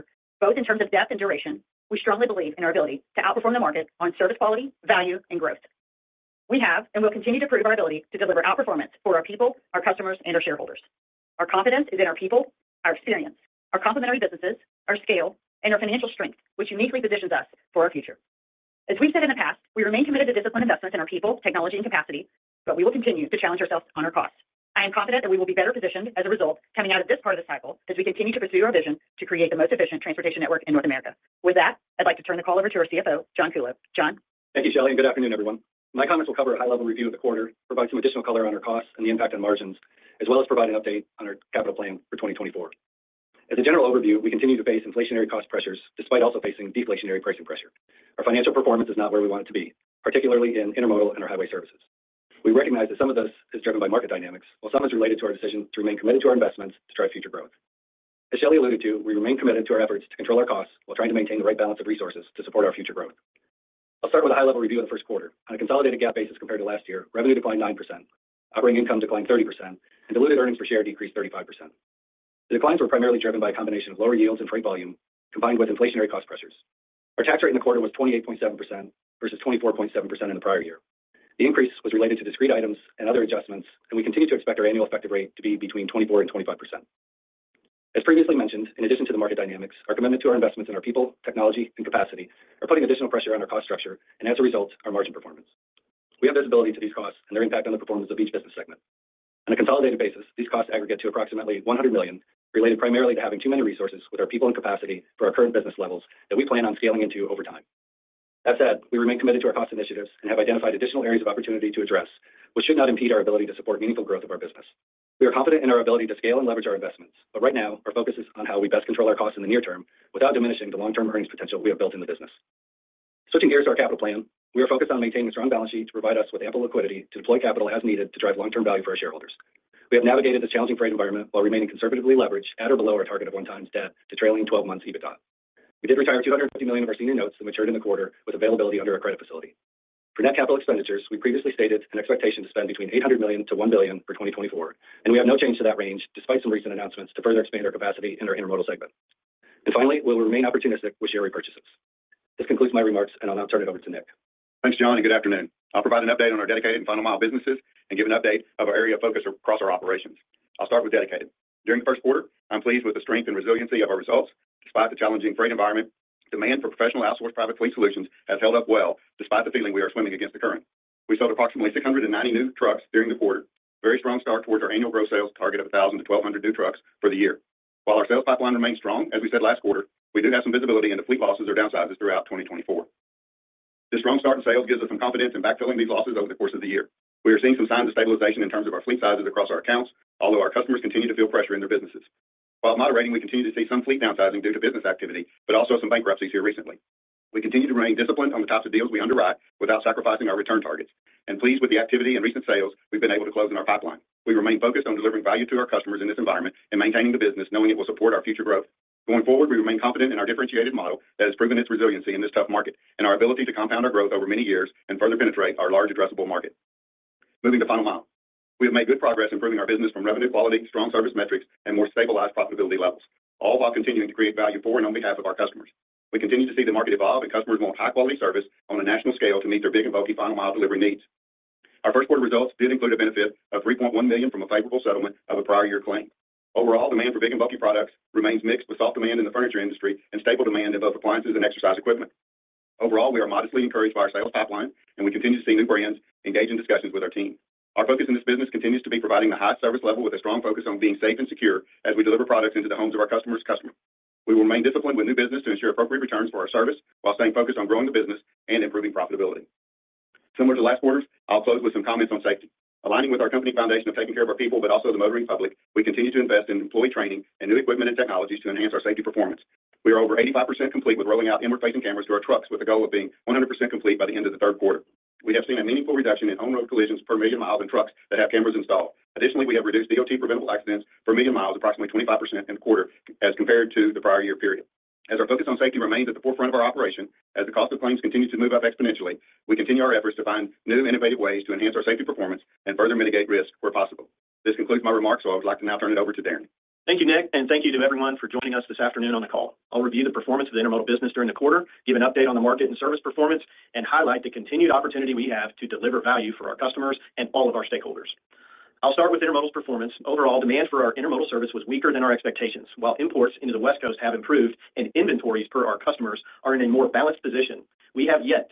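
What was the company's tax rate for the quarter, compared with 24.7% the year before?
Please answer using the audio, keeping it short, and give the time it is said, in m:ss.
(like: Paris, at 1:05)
28.7%, at 1:17.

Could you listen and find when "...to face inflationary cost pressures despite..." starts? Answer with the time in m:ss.
0:44.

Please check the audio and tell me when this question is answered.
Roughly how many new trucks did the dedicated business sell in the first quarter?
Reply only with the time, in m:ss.
2:51.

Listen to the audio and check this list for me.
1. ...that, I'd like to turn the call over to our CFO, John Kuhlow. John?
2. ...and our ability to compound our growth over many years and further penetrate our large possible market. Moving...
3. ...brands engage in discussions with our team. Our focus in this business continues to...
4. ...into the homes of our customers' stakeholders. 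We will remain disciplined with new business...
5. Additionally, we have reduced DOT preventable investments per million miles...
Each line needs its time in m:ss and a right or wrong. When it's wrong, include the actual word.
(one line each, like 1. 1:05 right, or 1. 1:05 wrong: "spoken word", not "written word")
1. 0:31 right
2. 3:32 wrong: "addressable", not "possible"
3. 4:05 right
4. 4:12 wrong: "customers", not "stakeholders"
5. 4:39 wrong: "accidents", not "investments".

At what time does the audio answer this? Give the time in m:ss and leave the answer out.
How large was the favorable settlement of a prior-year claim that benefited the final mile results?
3:53.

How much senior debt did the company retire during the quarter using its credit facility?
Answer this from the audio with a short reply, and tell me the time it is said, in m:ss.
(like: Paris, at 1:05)
$250 million, at 2:16.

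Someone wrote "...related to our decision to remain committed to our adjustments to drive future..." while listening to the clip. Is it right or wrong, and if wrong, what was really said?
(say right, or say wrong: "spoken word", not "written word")
wrong: "investments", not "adjustments".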